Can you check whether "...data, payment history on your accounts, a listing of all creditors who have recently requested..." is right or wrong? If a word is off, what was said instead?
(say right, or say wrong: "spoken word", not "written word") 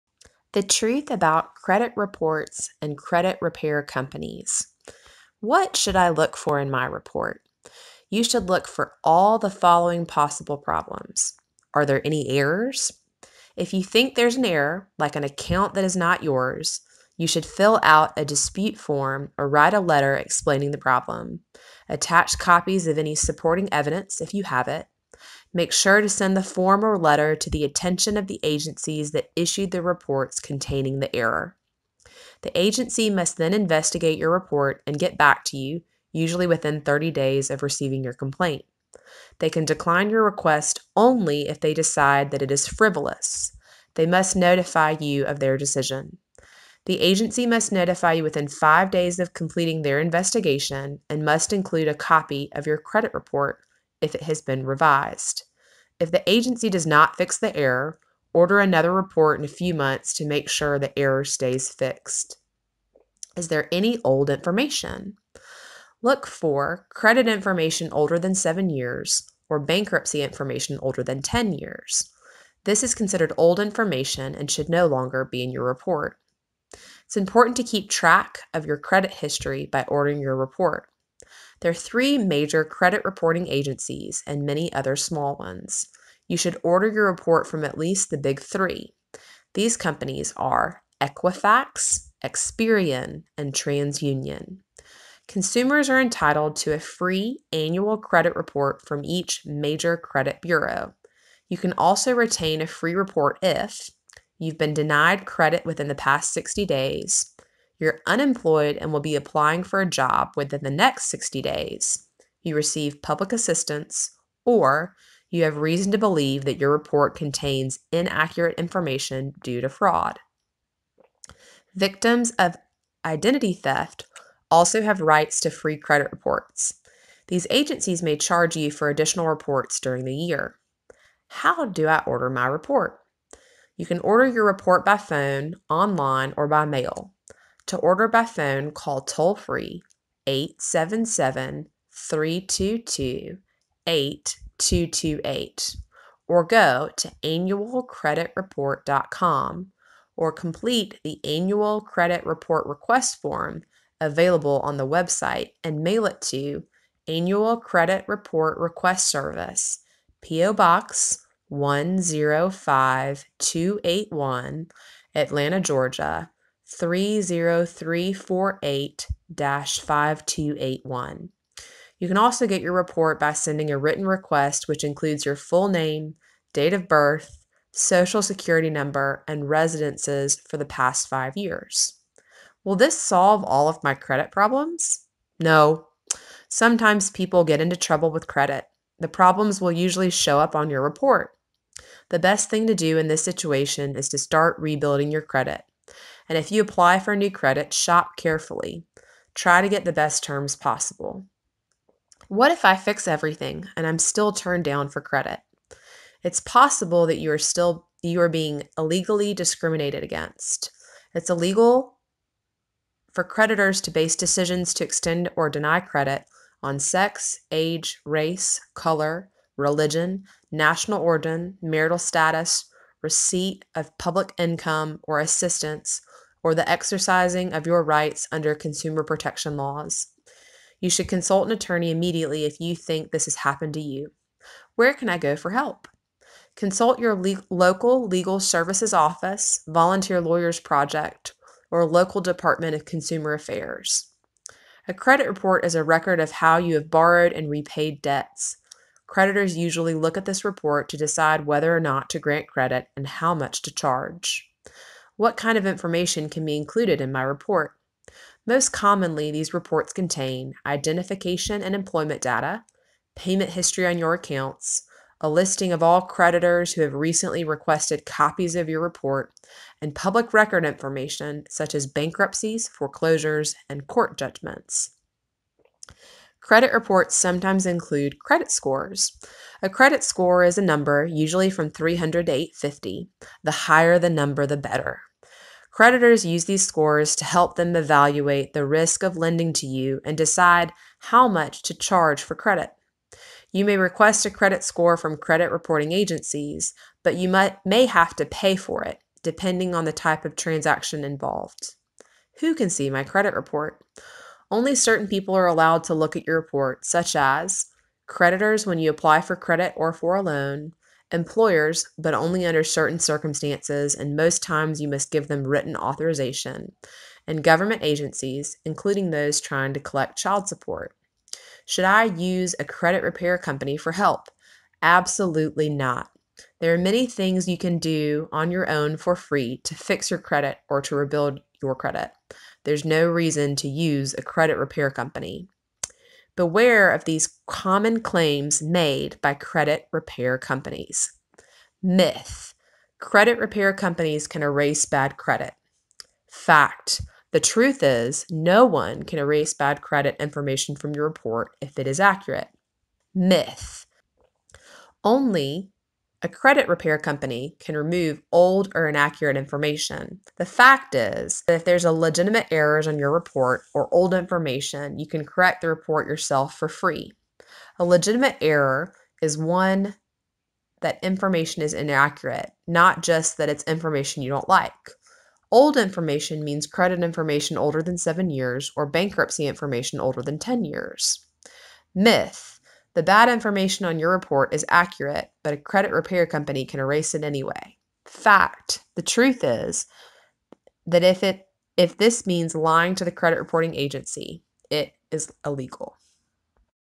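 right.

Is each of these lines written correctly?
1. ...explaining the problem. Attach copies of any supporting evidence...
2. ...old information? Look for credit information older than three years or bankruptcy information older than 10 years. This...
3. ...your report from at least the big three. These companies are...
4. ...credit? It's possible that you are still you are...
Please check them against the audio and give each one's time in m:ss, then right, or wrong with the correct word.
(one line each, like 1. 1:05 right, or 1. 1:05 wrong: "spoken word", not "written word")
1. 0:20 right
2. 1:04 wrong: "seven", not "three"
3. 1:26 right
4. 3:25 right.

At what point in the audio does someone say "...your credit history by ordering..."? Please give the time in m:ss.
1:18.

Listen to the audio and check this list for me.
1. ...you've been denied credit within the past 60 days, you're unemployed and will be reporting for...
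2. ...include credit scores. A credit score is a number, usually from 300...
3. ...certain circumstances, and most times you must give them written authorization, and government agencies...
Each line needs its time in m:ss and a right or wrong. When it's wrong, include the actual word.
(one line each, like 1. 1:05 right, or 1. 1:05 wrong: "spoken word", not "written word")
1. 1:44 wrong: "applying", not "reporting"
2. 4:37 right
3. 5:12 right.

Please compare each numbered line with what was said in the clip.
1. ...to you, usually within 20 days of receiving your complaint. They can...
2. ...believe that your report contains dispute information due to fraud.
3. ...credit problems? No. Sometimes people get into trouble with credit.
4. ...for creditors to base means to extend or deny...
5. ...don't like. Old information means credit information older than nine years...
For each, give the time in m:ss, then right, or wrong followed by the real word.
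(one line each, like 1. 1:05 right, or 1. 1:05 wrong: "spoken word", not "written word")
1. 0:35 wrong: "30", not "20"
2. 1:55 wrong: "inaccurate", not "dispute"
3. 3:03 right
4. 3:33 wrong: "decisions", not "means"
5. 6:14 wrong: "seven", not "nine".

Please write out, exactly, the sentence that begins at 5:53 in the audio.
Myth only a credit repair company can remove old or inaccurate information.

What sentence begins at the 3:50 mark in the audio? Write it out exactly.
You should consult an attorney immediately if you think this has happened to you.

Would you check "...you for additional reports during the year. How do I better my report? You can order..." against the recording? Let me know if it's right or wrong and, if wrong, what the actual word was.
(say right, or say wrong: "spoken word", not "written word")
wrong: "order", not "better".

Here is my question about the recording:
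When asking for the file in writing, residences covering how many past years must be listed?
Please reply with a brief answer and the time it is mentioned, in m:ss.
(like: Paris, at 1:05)
5 years, at 3:00.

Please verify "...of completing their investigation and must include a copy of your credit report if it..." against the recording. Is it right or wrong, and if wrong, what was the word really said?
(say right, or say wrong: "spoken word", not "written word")
right.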